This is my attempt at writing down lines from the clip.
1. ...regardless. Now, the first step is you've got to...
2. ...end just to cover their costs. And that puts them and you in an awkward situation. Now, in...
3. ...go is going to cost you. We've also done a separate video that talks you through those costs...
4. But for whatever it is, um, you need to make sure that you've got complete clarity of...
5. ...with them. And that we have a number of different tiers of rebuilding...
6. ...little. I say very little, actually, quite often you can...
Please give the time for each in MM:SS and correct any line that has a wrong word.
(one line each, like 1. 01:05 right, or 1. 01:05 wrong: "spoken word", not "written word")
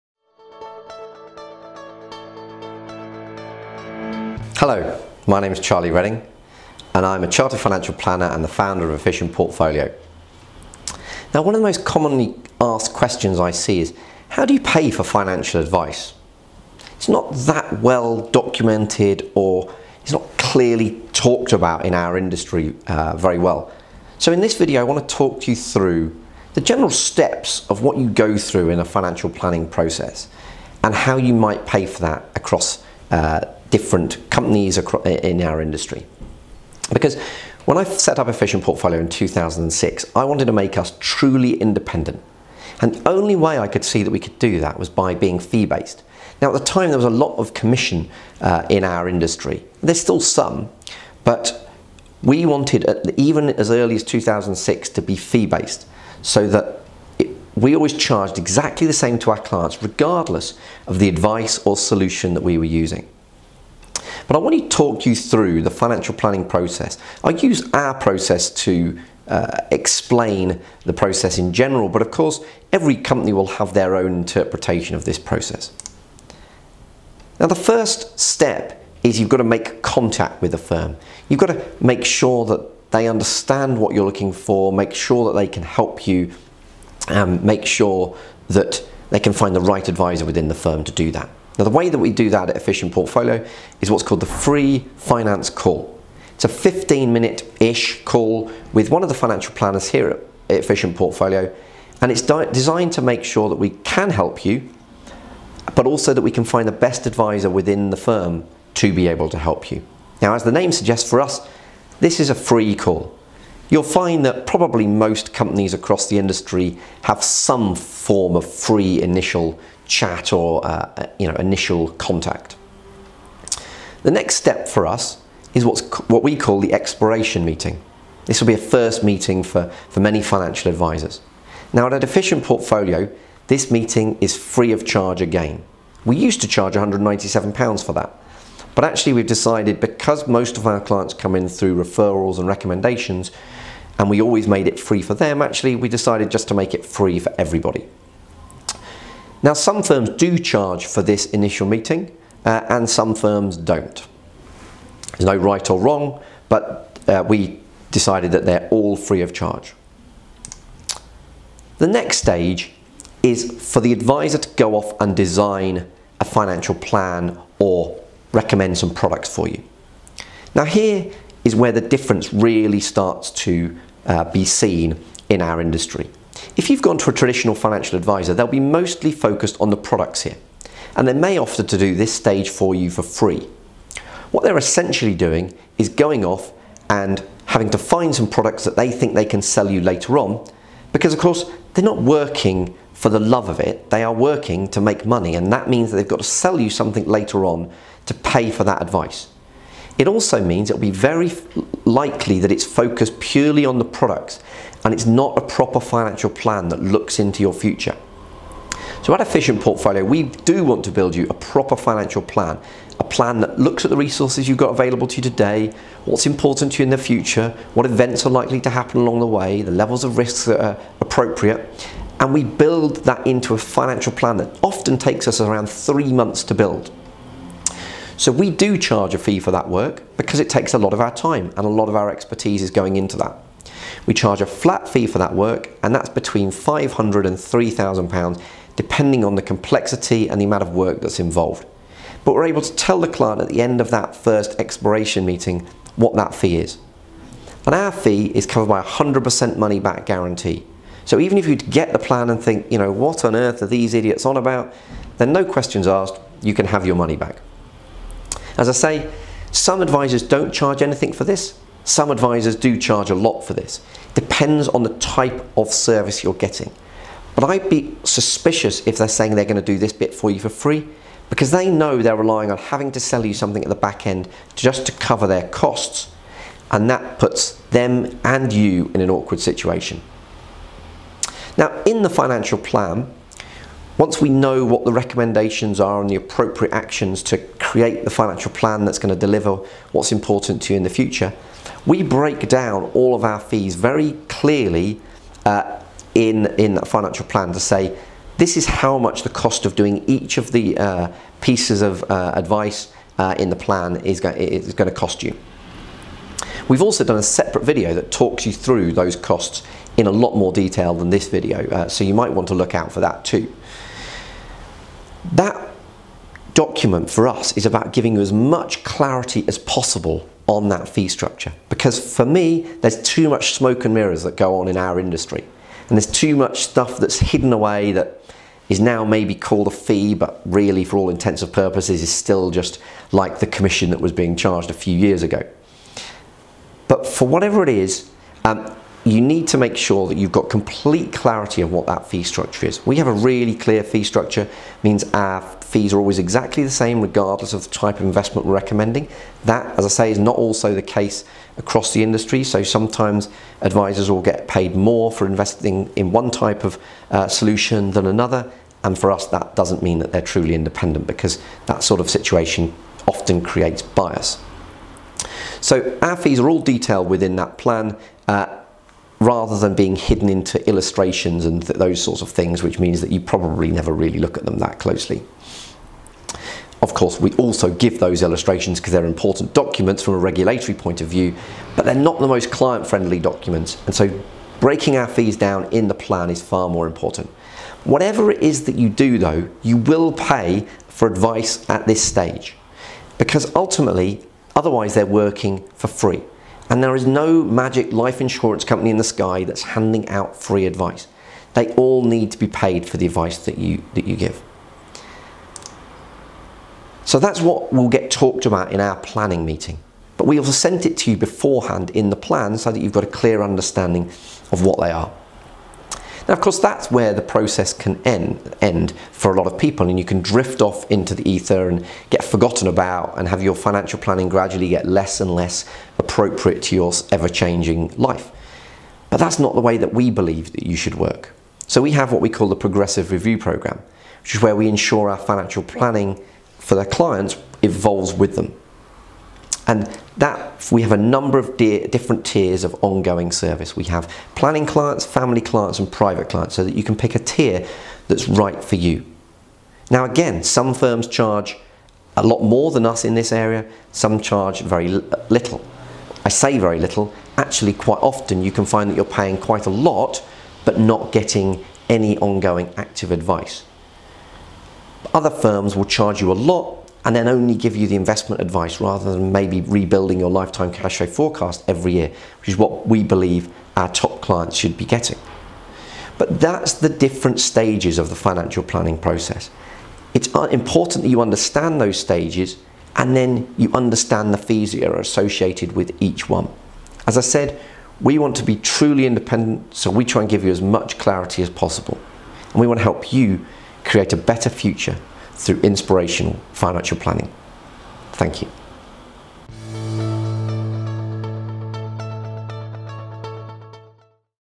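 1. 01:15 wrong: "process", not "regardless"
2. 04:34 right
3. 05:04 right
4. 05:36 right
5. 07:18 wrong: "ongoing", not "rebuilding"
6. 07:34 right.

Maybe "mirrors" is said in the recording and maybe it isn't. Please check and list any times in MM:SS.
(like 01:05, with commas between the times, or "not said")
05:23.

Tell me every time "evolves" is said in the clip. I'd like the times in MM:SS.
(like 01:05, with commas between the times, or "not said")
07:17.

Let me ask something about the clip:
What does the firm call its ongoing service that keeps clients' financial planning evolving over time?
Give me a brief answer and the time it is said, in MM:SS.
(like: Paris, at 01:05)
progressive review program, at 07:12.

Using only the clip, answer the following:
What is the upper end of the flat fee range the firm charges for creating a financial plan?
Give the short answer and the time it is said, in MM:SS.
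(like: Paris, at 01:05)
3,000 pounds, at 03:57.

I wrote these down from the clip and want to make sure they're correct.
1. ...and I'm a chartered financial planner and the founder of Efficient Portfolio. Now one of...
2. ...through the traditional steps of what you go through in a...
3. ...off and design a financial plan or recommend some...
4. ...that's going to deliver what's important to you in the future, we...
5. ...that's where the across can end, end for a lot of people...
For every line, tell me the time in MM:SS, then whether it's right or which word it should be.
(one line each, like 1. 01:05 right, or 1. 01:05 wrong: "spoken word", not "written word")
1. 00:06 right
2. 00:25 wrong: "general", not "traditional"
3. 02:44 right
4. 04:48 right
5. 06:56 wrong: "process", not "across".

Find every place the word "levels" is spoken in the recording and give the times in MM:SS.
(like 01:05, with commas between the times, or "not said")
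03:39.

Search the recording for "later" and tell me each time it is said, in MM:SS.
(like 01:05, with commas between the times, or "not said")
03:09, 03:17.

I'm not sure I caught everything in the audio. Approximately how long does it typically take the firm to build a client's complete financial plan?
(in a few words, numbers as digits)
three months.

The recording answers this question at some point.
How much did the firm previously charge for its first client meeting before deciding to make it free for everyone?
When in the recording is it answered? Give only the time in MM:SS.
02:16.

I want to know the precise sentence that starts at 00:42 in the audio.
And the only way I could see that we could do that was by being fee-based.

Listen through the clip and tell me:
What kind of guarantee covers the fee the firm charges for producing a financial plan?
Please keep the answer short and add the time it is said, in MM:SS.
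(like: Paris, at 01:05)
100% money back guarantee, at 04:08.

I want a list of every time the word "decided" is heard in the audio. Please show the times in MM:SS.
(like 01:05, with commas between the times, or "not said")
02:19, 02:25, 02:37.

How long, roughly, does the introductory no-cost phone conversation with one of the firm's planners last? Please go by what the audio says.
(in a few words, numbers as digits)
15 minutes.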